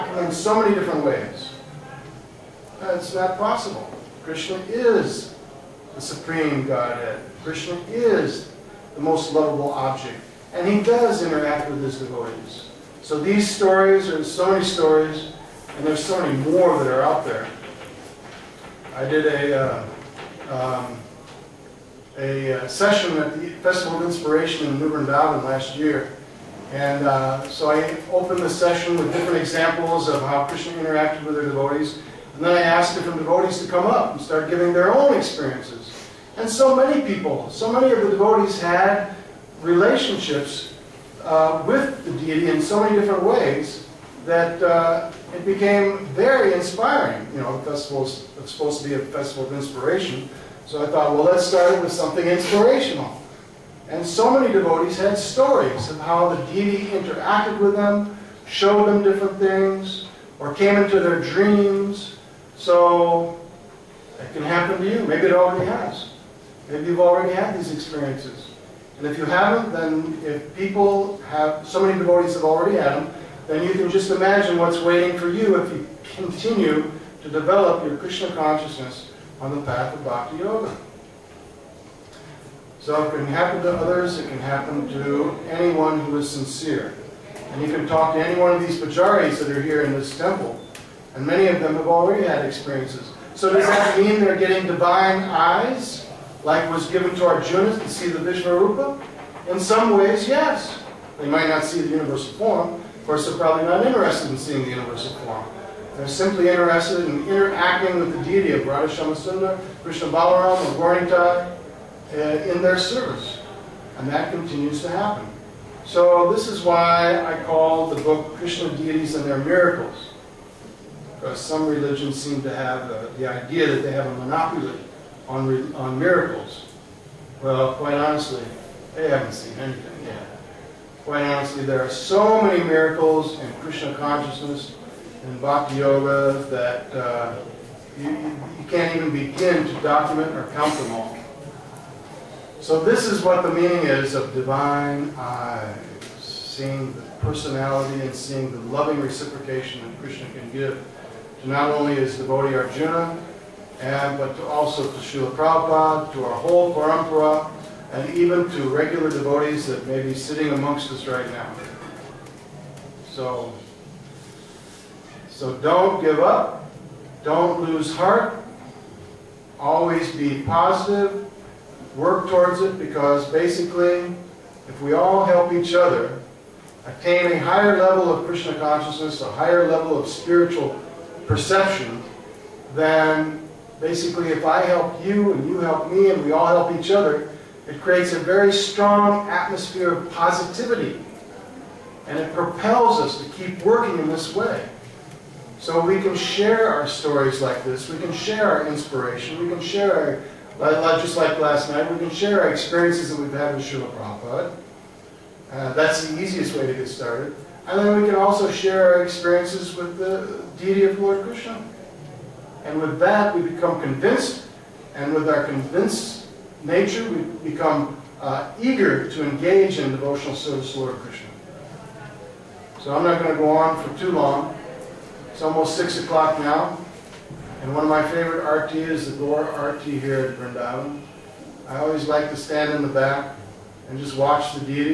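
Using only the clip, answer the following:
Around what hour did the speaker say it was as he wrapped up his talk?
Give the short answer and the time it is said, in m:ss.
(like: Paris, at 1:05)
6 o'clock, at 3:45.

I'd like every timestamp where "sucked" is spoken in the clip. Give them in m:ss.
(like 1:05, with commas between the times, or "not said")
not said.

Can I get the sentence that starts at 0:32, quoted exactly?
And then I asked different devotees to come up and start giving their own experiences.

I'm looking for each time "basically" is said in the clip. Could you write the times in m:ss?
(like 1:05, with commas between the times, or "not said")
2:53, 3:03.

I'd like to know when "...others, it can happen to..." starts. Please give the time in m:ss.
1:23.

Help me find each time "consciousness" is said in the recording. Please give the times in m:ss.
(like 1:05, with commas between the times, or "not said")
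1:18, 2:13, 2:58.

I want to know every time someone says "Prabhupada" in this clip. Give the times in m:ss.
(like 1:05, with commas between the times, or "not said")
2:35, 3:23.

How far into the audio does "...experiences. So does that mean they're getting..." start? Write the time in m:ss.
1:32.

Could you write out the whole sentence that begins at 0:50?
So I thought, well, let's start it with something inspirational.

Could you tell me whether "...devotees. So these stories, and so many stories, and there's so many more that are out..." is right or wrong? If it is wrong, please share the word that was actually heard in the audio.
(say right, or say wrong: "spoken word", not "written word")
right.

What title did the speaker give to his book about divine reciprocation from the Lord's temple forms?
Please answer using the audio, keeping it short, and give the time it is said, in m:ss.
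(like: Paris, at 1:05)
Krishna Deities and Their Miracles, at 1:58.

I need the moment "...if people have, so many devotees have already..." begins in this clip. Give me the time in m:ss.
1:10.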